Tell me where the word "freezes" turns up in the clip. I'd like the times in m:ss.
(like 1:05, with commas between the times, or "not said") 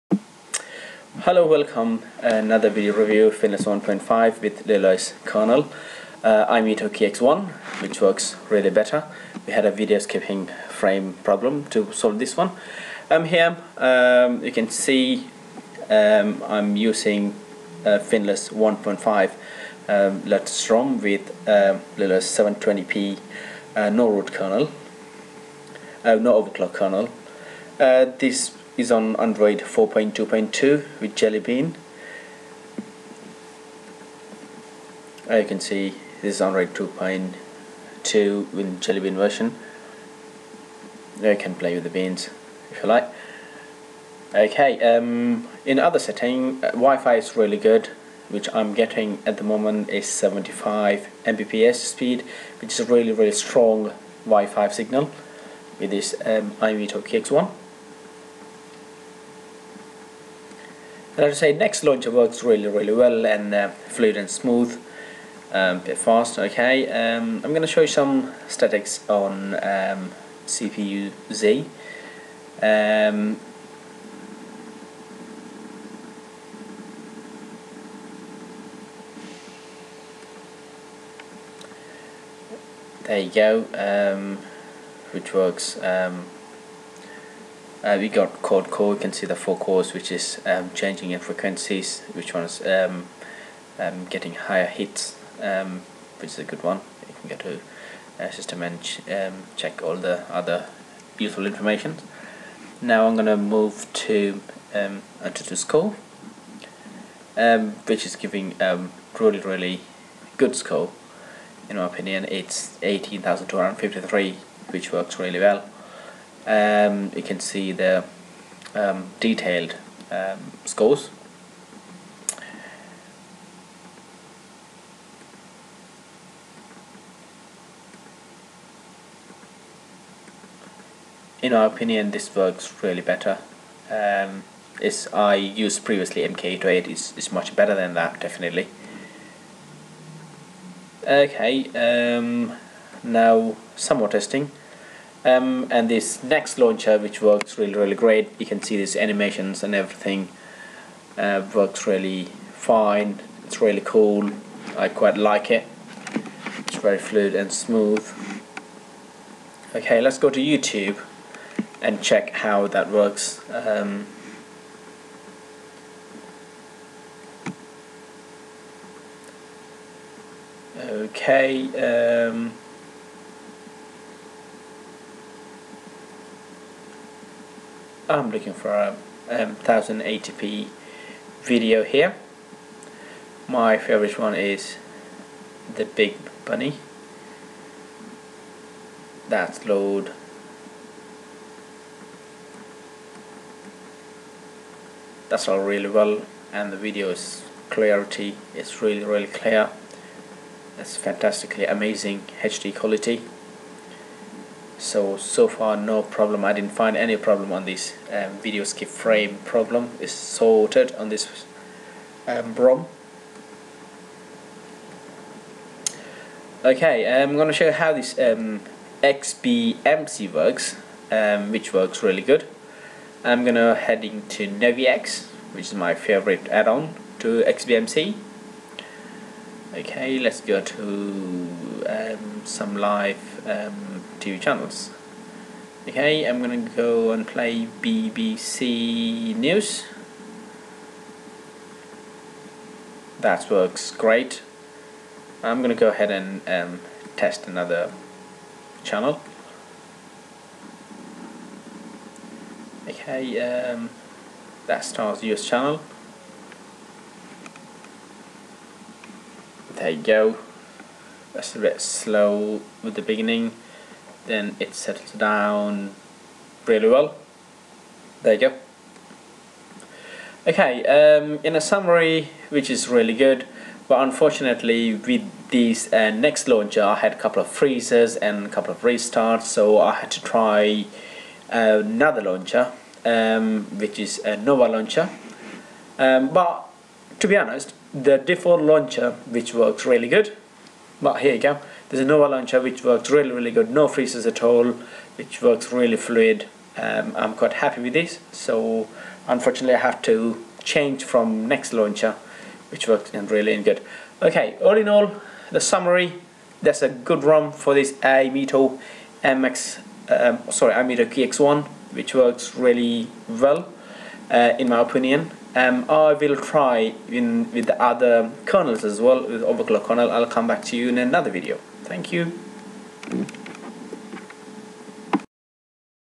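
4:37, 4:53.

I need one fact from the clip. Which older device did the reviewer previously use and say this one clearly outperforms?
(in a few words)
MK808.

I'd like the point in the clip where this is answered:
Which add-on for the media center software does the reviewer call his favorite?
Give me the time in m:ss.
3:44.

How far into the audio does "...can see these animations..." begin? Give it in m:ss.
2:28.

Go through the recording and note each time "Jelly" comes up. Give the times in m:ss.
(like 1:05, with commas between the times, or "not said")
0:31, 0:38.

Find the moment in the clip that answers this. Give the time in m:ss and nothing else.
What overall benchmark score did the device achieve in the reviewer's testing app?
1:52.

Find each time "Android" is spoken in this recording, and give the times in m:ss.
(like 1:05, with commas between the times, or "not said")
0:29, 0:36.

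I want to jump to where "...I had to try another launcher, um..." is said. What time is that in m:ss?
4:39.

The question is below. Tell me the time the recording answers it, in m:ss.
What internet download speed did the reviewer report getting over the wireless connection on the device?
0:50.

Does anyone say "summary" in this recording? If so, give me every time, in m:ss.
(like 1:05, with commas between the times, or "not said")
4:31, 5:05.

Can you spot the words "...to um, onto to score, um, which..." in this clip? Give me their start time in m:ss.
1:43.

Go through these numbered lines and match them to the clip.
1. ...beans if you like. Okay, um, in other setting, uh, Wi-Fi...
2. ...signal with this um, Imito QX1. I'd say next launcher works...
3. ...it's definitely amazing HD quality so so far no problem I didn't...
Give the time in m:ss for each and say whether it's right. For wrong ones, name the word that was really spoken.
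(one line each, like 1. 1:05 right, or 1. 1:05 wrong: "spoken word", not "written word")
1. 0:41 right
2. 0:54 right
3. 3:20 wrong: "fantastically", not "definitely".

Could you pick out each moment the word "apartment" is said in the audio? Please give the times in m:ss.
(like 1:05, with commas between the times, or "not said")
not said.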